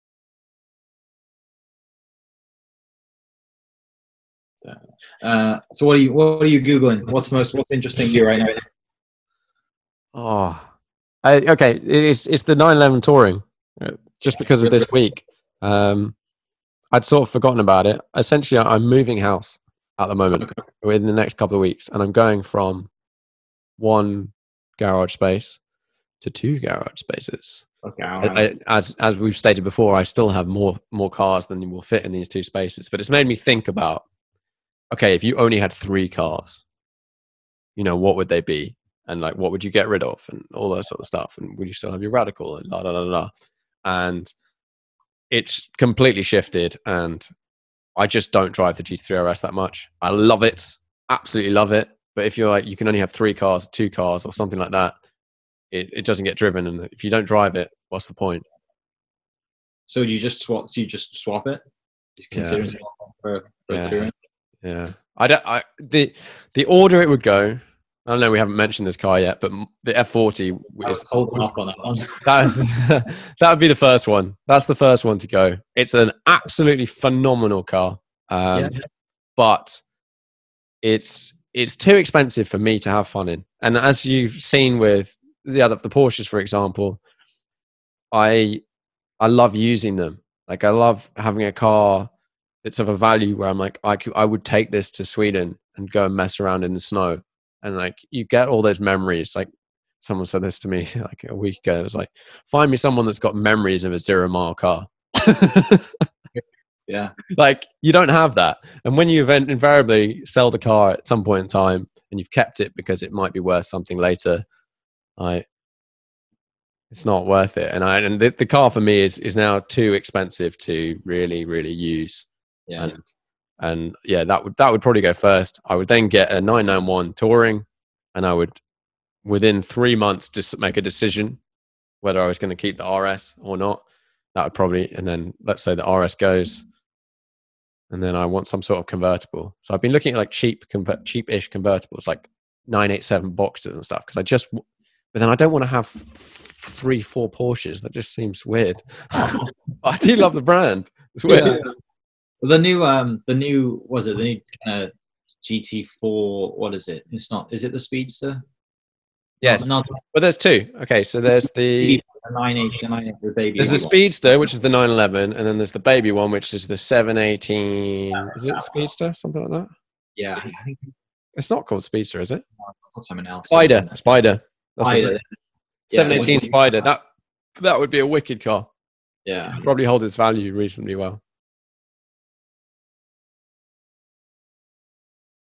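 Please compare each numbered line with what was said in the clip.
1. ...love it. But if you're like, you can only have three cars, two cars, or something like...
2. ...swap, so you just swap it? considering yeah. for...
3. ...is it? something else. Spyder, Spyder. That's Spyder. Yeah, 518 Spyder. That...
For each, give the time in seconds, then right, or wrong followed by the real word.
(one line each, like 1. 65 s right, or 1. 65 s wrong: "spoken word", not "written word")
1. 51 s right
2. 60 s right
3. 172 s wrong: "718", not "518".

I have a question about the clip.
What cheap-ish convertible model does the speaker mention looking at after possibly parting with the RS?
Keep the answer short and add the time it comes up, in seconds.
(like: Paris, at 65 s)
987 Boxster, at 142 s.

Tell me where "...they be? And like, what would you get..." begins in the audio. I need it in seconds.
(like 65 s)
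38 s.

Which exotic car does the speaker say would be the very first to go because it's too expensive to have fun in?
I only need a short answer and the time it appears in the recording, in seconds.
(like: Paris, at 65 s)
F40, at 69 s.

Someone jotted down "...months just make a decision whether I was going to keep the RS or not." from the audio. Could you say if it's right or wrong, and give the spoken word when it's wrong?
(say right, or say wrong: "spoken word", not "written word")
right.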